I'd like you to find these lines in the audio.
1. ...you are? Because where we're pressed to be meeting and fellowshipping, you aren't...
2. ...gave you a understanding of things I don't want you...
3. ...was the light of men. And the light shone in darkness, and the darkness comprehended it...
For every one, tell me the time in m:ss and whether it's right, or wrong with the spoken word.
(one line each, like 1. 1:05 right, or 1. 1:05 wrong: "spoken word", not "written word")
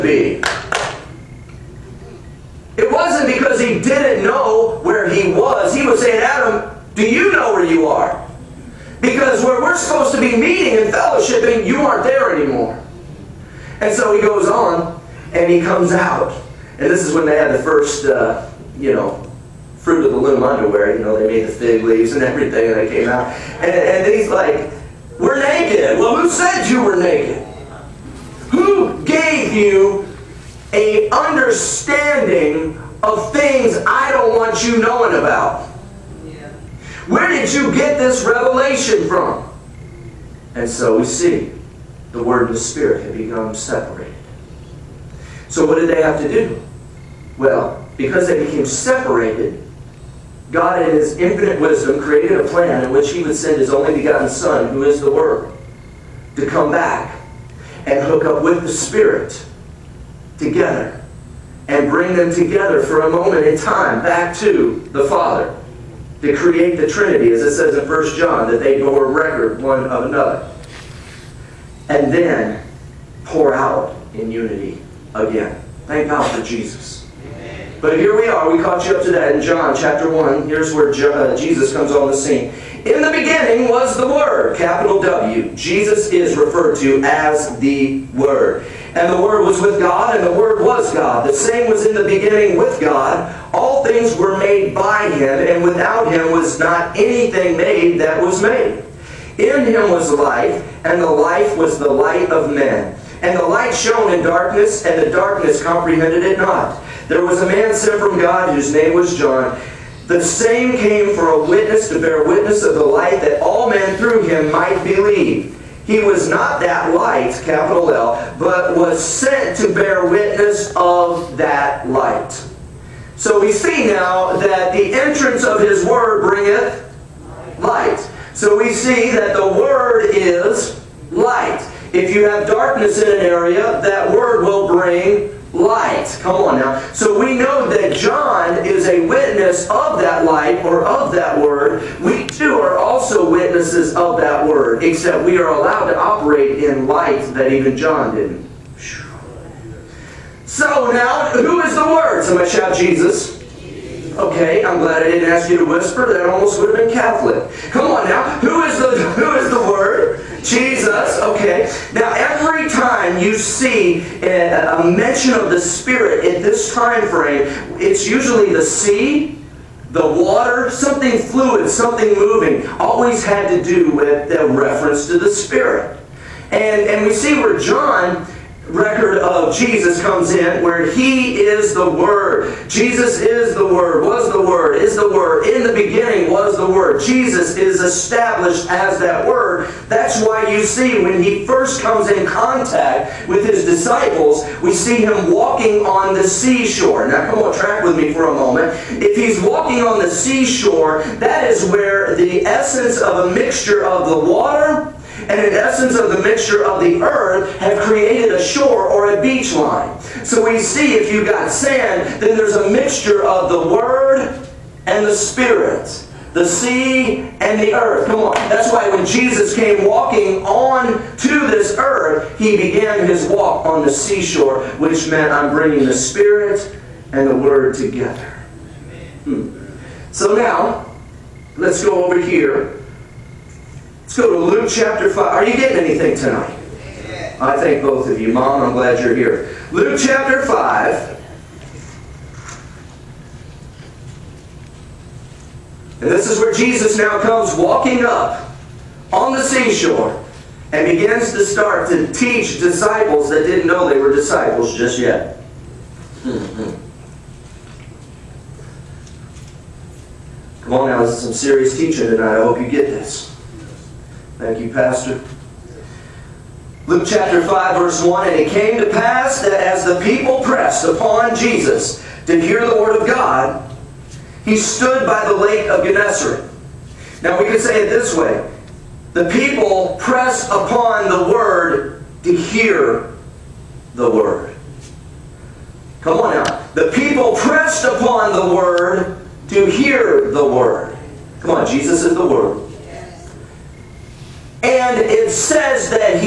1. 0:07 wrong: "supposed", not "pressed"
2. 0:29 right
3. 1:41 right.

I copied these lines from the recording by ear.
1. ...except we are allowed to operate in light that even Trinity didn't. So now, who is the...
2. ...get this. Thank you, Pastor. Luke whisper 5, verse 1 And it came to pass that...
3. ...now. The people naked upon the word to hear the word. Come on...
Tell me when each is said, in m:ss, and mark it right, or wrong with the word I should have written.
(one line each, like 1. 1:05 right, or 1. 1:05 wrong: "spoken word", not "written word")
1. 2:24 wrong: "John", not "Trinity"
2. 4:22 wrong: "chapter", not "whisper"
3. 4:46 wrong: "pressed", not "naked".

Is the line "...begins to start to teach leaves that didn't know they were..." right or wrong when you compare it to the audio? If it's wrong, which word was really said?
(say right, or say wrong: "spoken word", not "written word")
wrong: "disciples", not "leaves".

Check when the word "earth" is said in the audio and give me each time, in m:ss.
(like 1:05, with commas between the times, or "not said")
3:27, 3:37, 3:41.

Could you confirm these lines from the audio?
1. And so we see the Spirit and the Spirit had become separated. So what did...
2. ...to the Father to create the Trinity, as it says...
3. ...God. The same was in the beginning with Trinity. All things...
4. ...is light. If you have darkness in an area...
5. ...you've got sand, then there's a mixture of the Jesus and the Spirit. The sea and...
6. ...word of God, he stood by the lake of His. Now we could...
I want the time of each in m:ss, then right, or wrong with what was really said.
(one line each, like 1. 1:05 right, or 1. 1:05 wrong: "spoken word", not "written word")
1. 0:40 wrong: "Word", not "Spirit"
2. 1:04 right
3. 1:30 wrong: "God", not "Trinity"
4. 2:10 right
5. 3:31 wrong: "Word", not "Jesus"
6. 4:32 wrong: "Gennesaret", not "His".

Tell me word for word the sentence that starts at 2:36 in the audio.
That almost would have been Catholic.